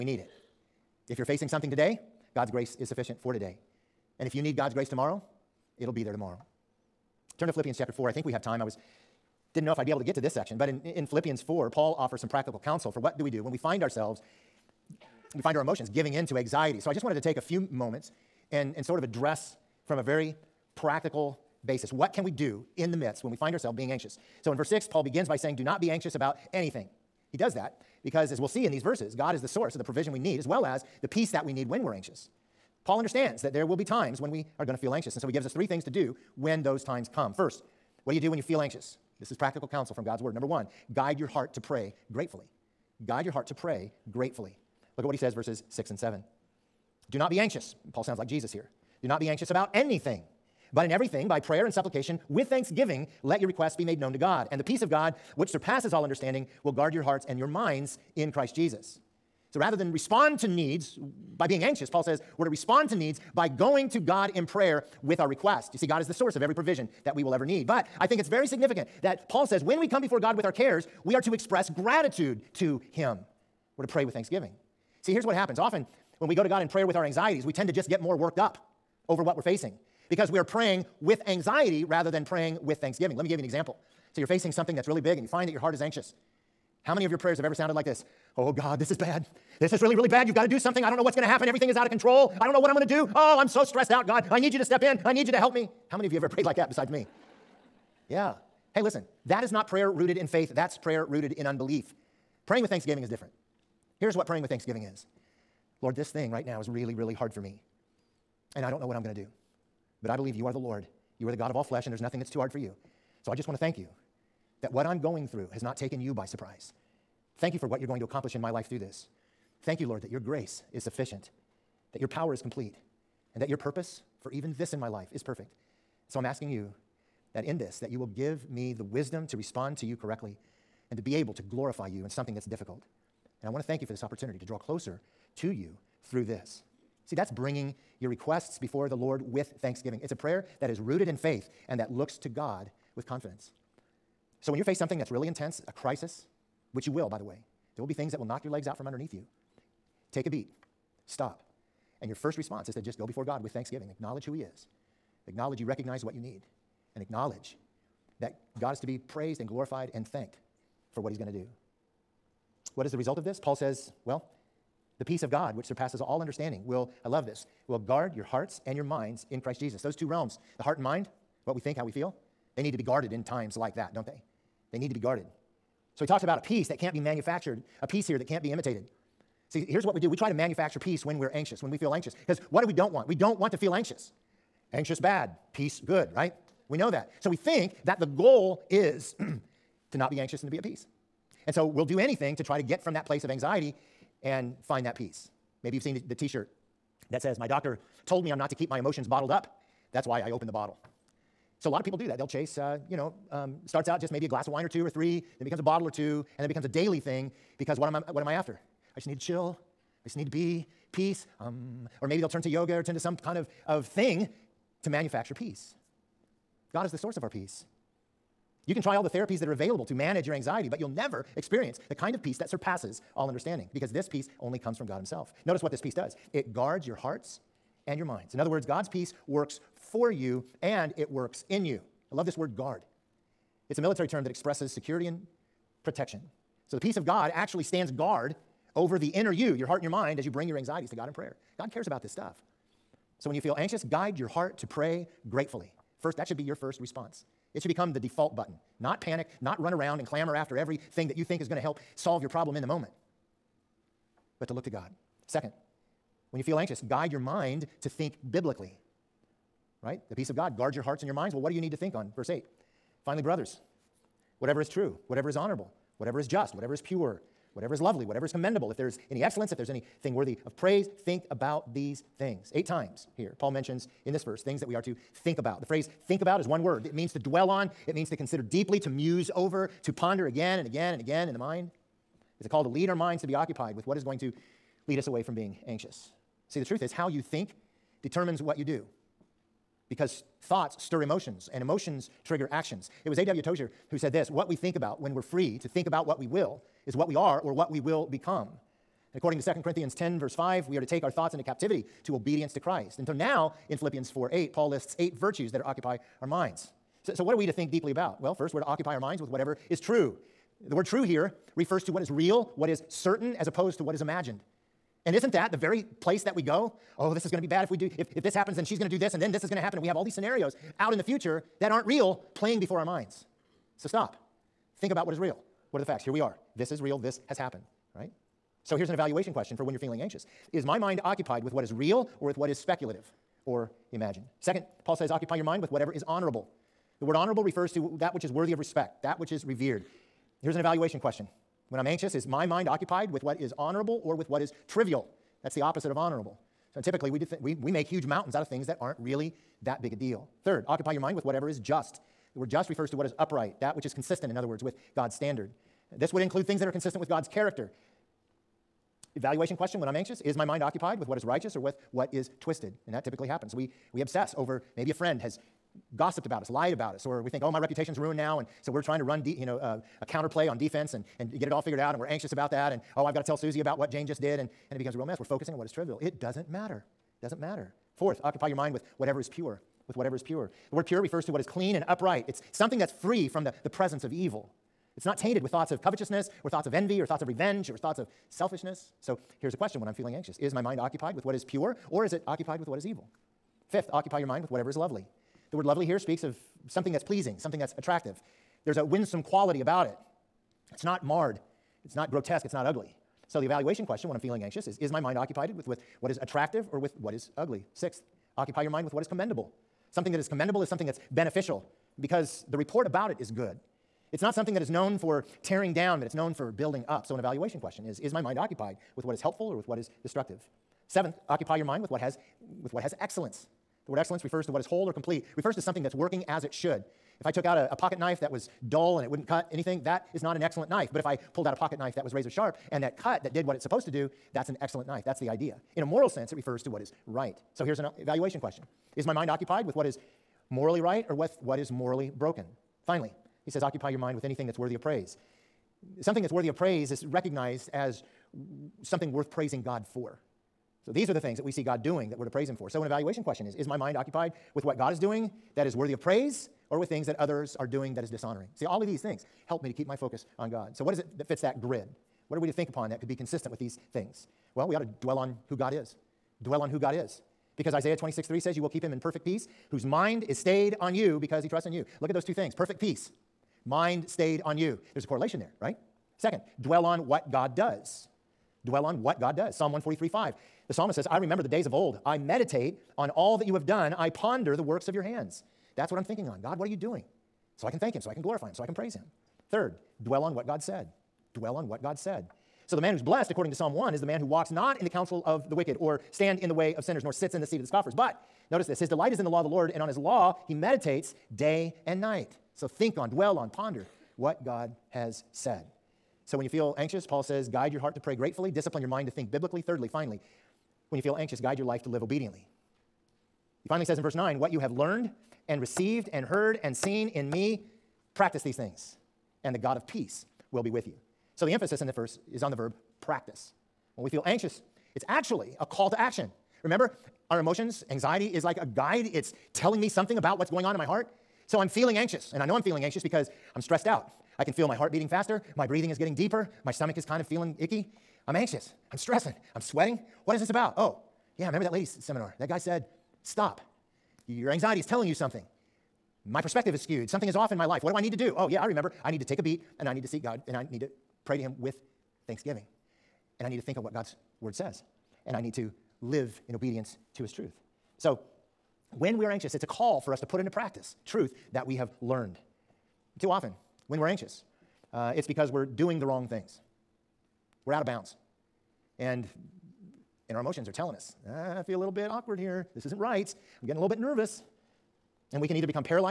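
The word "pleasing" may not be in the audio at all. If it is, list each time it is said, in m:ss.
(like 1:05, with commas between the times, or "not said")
6:37.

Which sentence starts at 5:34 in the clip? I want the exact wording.
Second, Paul says, occupy your mind with whatever is honorable.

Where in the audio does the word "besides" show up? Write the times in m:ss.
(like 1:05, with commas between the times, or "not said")
1:36.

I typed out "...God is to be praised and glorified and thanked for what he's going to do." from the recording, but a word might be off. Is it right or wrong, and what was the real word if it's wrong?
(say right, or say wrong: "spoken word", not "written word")
right.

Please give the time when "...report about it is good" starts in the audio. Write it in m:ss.
6:52.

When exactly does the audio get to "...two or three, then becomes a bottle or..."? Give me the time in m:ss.
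3:24.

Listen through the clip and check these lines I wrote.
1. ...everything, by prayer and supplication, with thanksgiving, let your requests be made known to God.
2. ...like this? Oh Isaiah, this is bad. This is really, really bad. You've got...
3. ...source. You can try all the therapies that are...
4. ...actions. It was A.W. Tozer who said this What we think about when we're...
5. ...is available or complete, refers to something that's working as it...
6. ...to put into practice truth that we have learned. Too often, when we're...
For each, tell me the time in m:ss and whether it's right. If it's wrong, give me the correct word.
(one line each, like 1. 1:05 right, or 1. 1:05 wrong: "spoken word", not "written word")
1. 0:50 right
2. 1:27 wrong: "God", not "Isaiah"
3. 3:37 wrong: "peace", not "source"
4. 4:52 right
5. 7:04 wrong: "whole", not "available"
6. 9:20 right.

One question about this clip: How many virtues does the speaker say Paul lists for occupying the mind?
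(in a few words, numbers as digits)
8.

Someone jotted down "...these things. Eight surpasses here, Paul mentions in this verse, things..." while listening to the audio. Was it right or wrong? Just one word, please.
wrong.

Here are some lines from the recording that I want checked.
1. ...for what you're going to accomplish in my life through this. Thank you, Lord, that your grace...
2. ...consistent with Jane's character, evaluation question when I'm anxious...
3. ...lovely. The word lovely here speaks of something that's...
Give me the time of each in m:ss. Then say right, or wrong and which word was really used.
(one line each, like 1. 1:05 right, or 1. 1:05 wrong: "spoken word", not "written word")
1. 1:57 right
2. 5:56 wrong: "God", not "Jane"
3. 6:34 right.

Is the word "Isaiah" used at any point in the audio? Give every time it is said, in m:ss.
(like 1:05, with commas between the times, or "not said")
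7:47.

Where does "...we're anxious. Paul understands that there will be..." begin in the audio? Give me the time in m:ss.
0:31.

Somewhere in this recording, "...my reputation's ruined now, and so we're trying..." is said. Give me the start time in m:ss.
6:07.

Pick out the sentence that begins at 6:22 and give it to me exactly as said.
It's something that's free from the, the presence of evil.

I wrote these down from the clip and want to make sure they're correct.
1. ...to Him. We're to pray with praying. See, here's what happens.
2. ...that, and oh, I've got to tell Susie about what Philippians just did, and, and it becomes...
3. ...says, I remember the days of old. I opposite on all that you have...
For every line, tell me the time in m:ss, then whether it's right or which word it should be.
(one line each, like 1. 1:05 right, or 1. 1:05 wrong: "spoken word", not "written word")
1. 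1:12 wrong: "thanksgiving", not "praying"
2. 6:12 wrong: "Jane", not "Philippians"
3. 8:00 wrong: "meditate", not "opposite".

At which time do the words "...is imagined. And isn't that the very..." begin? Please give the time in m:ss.
5:13.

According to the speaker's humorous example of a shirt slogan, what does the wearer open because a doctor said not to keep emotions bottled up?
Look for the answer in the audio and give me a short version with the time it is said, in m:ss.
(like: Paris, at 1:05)
The bottle, at 3:20.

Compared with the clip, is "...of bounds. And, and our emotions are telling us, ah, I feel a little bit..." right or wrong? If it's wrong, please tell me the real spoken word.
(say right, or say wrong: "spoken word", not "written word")
right.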